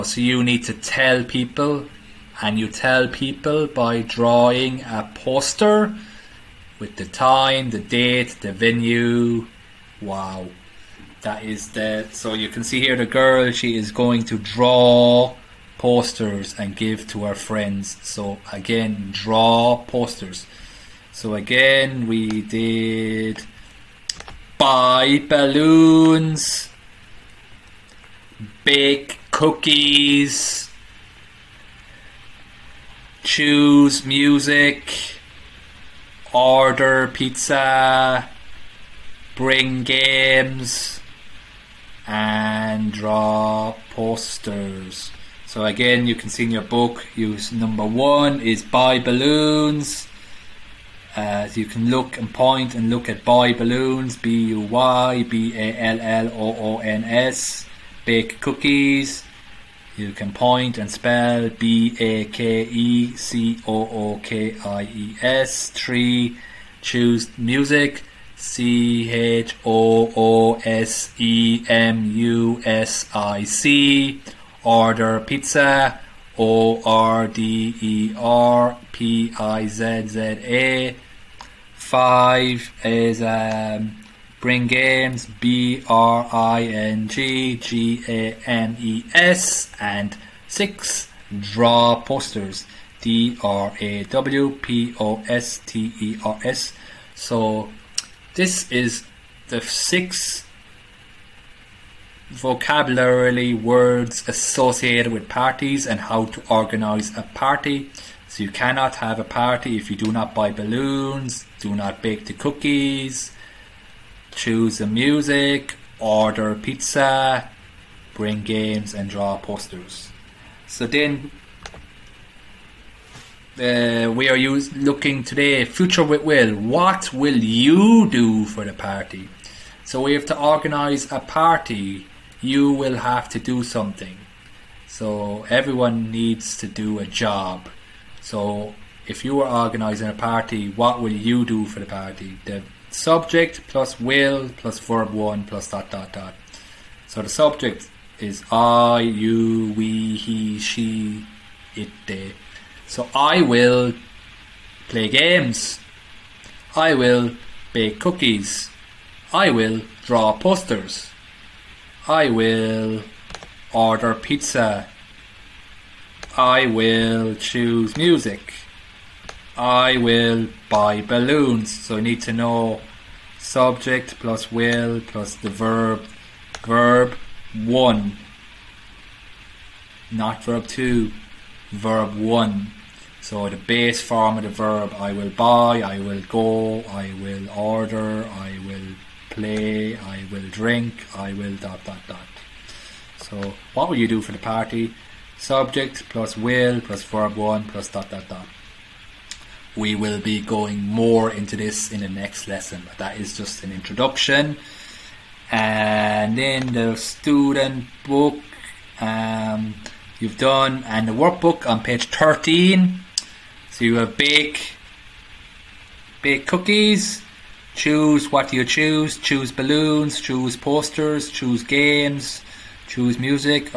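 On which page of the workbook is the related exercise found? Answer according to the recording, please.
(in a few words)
page 13.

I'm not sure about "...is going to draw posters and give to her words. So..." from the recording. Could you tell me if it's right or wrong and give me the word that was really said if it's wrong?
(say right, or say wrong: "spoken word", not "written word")
wrong: "friends", not "words".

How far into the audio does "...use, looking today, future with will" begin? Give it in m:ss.
2:04.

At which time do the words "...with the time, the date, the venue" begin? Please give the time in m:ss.
0:06.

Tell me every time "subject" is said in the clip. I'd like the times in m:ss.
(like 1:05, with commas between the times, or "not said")
2:22, 2:27, 2:53, 3:15.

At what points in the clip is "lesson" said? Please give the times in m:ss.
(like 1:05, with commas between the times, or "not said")
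3:22.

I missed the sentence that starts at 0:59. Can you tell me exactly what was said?
You can point and spell B A K E C O O K I E S.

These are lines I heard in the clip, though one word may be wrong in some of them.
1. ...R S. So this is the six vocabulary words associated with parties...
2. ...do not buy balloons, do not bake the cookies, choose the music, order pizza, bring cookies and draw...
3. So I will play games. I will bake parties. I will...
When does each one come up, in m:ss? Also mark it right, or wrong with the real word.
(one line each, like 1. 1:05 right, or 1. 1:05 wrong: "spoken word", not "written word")
1. 1:36 right
2. 1:49 wrong: "games", not "cookies"
3. 2:32 wrong: "cookies", not "parties".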